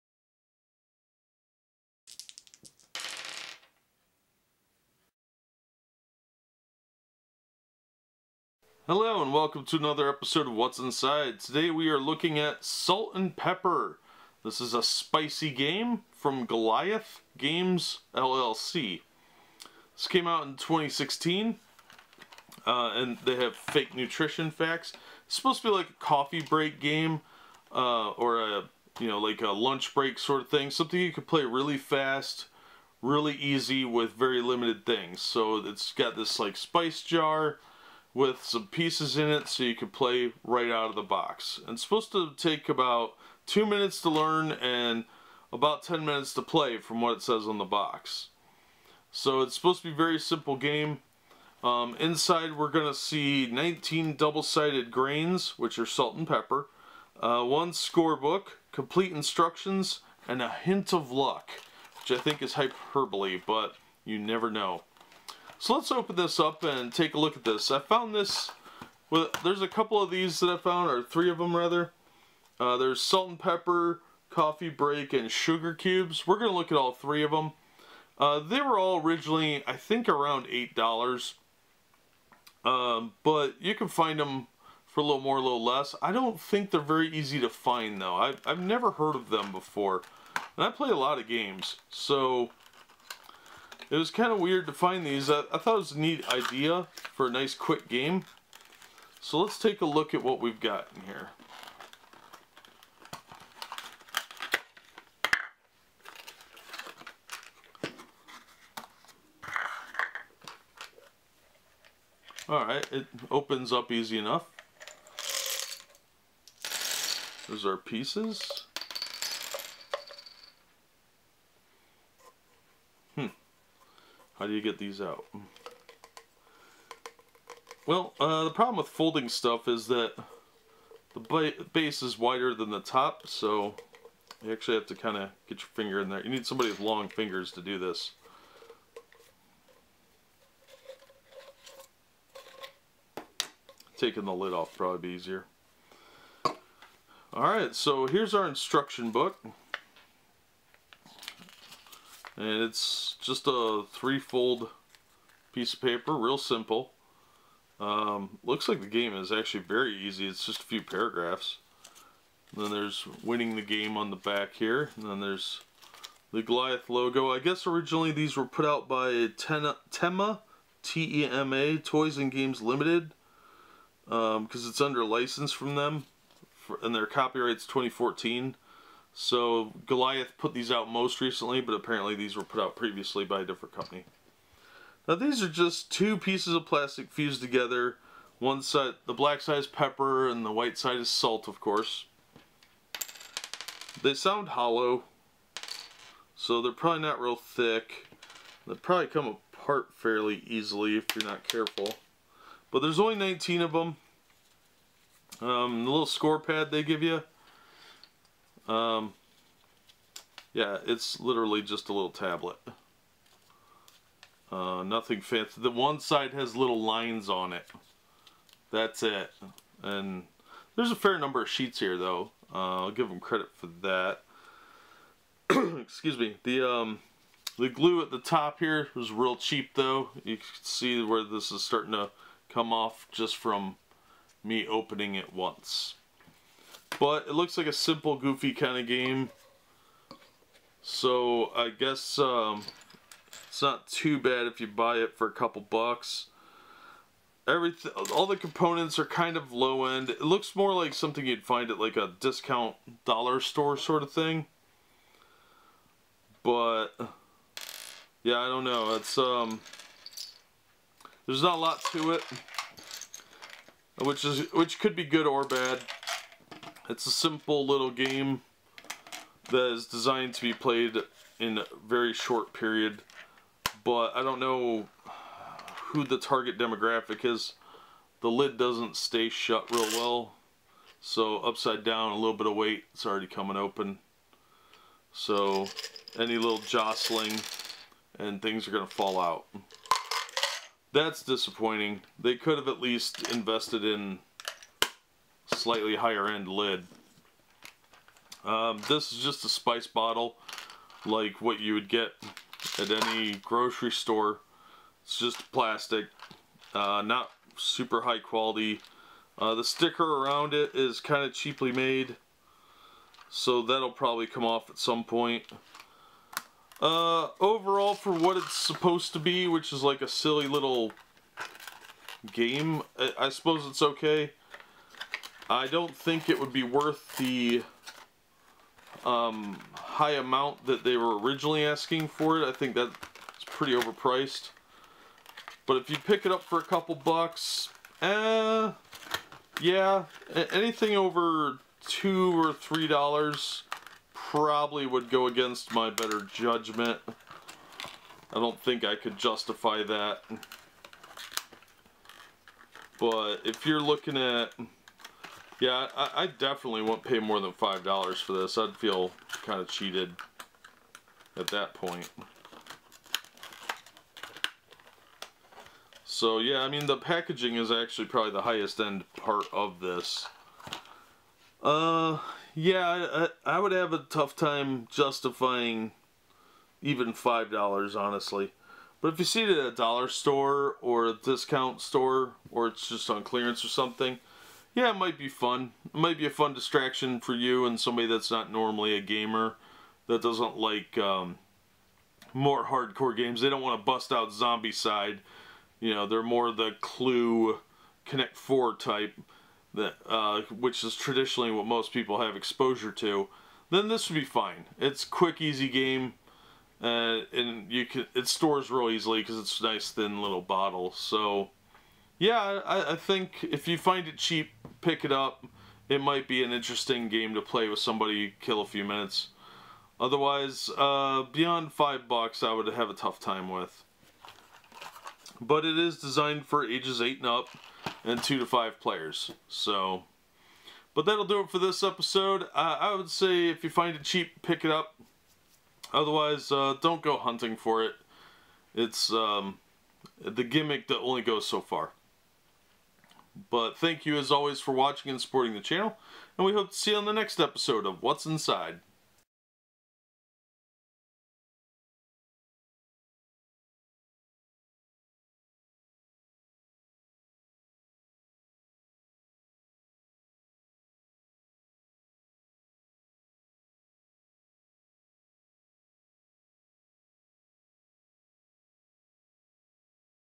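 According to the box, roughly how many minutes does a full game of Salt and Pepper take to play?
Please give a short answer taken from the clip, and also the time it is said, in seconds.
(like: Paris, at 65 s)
10, at 45 s.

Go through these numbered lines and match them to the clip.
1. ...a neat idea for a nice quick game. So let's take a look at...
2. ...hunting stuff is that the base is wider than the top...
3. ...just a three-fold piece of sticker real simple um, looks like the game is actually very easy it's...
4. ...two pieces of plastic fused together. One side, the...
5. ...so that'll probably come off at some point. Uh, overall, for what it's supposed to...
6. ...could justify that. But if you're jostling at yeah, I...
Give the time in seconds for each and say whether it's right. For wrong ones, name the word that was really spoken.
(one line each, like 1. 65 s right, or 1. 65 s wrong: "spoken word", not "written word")
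1. 95 s right
2. 128 s wrong: "folding", not "hunting"
3. 153 s wrong: "paper", not "sticker"
4. 185 s right
5. 313 s right
6. 348 s wrong: "looking", not "jostling".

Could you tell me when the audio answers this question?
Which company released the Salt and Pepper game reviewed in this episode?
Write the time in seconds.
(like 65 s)
16 s.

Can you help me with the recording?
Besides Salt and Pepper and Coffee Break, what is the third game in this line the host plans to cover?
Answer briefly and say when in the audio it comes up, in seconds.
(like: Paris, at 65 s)
Sugar Cubes, at 75 s.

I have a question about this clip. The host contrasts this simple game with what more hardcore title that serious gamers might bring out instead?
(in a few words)
Zombicide.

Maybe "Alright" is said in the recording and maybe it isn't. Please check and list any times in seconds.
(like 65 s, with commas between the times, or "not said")
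112 s, 147 s.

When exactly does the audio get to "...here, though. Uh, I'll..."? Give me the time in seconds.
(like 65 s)
221 s.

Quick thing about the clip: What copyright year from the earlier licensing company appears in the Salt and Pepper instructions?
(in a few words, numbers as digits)
2014.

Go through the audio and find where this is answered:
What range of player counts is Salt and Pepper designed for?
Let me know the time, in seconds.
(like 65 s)
428 s.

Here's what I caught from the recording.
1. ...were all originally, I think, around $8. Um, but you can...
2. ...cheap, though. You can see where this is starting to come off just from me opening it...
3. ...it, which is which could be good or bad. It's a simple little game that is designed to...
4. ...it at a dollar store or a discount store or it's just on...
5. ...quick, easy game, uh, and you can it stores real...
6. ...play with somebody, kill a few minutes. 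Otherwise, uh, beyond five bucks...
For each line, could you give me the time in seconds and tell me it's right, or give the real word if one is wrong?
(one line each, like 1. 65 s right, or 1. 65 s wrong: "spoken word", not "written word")
1. 78 s right
2. 229 s right
3. 262 s right
4. 379 s right
5. 405 s right
6. 417 s right.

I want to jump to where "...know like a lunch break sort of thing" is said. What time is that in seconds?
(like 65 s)
29 s.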